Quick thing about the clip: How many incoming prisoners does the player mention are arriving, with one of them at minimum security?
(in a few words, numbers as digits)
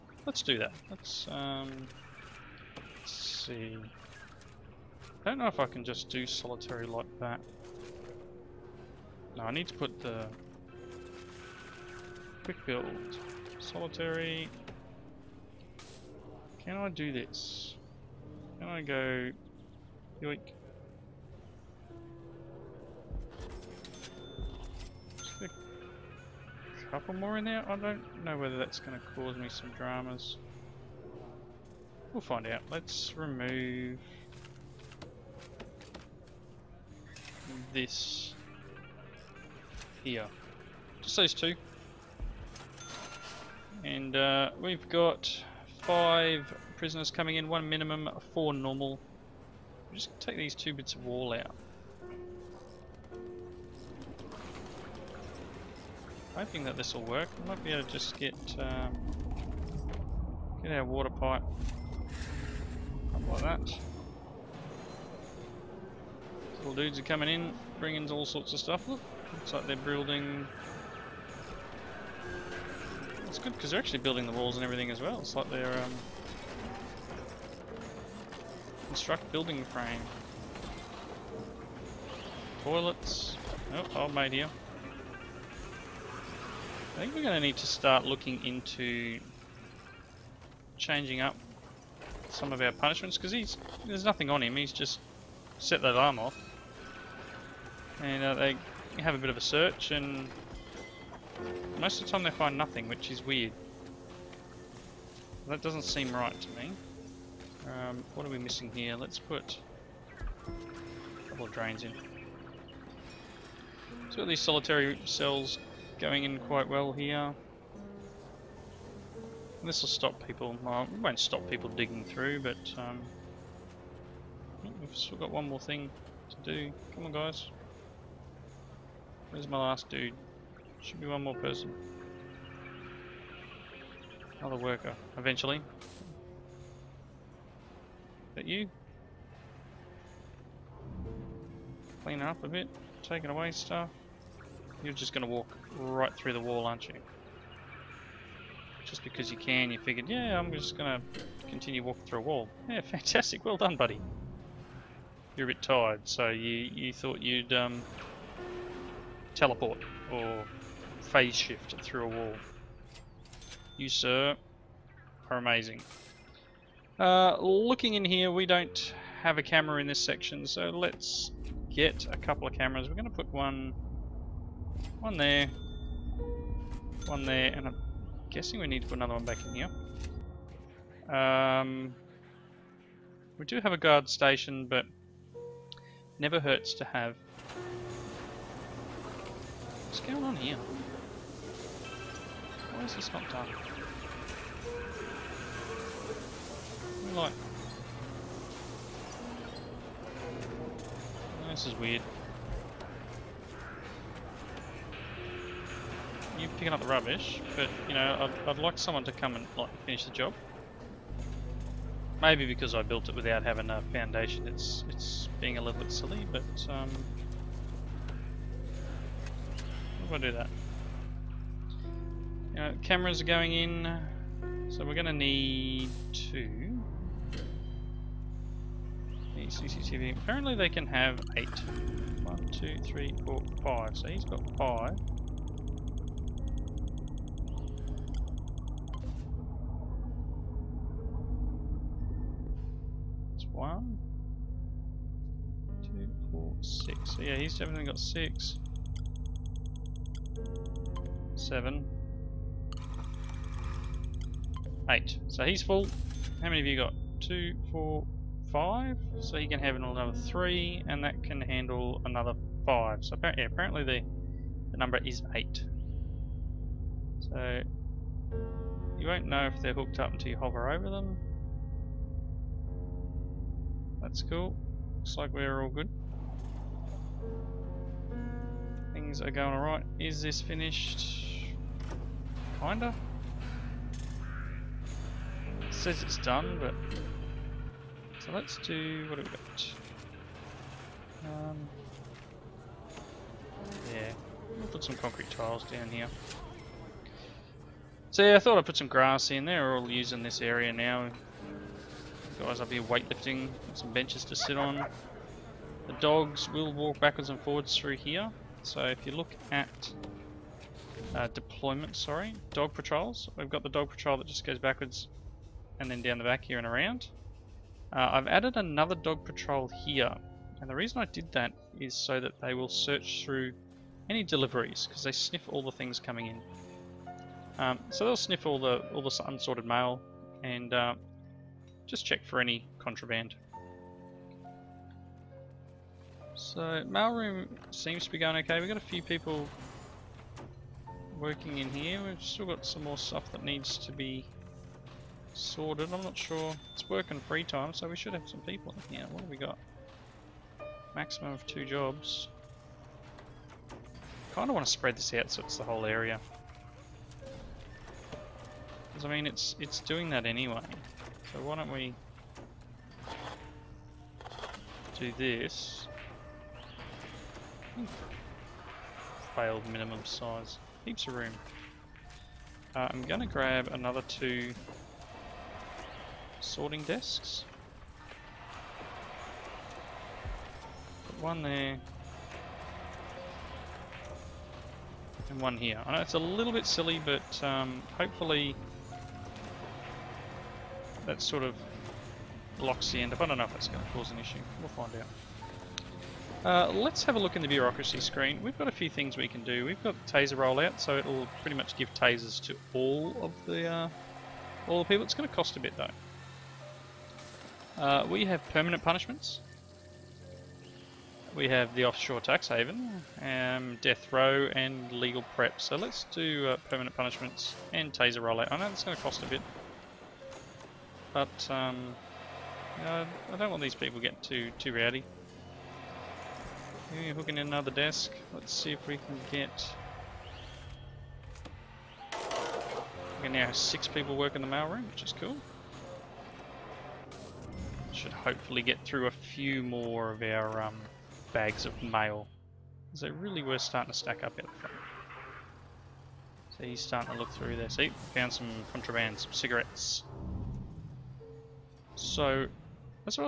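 5.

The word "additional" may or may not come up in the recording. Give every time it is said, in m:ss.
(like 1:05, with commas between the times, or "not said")
not said.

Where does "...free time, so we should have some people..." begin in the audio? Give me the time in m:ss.
5:47.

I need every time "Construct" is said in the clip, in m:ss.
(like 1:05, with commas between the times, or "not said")
1:18.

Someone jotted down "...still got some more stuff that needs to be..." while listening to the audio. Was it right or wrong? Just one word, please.
right.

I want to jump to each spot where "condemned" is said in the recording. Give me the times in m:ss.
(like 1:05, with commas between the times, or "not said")
not said.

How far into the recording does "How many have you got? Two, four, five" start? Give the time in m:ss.
4:16.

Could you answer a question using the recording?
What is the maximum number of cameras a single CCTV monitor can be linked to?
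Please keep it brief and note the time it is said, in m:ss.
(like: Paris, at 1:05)
8, at 4:24.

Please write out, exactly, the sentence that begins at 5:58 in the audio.
Because, I mean, it's, it's doing that anyway.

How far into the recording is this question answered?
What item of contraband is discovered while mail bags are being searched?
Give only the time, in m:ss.
7:29.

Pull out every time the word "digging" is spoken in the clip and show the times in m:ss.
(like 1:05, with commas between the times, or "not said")
2:01.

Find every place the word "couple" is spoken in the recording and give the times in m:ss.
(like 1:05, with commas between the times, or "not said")
0:26, 1:51, 2:52.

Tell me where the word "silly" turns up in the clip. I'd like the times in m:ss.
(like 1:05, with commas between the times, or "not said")
3:35, 6:26.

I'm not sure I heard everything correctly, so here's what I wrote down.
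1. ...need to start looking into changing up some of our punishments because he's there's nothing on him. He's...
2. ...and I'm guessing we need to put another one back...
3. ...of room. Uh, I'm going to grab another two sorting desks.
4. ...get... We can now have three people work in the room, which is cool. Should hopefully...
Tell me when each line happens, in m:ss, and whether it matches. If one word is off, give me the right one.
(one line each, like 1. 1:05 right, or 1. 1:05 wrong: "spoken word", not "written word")
1. 1:27 right
2. 2:57 right
3. 6:11 right
4. 7:09 wrong: "six", not "three".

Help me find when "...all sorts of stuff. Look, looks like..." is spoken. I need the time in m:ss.
1:08.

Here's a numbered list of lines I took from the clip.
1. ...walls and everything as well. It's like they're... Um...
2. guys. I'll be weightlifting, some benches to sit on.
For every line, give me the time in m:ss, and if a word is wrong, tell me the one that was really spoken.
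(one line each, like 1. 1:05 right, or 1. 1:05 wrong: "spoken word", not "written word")
1. 1:14 right
2. 5:02 right.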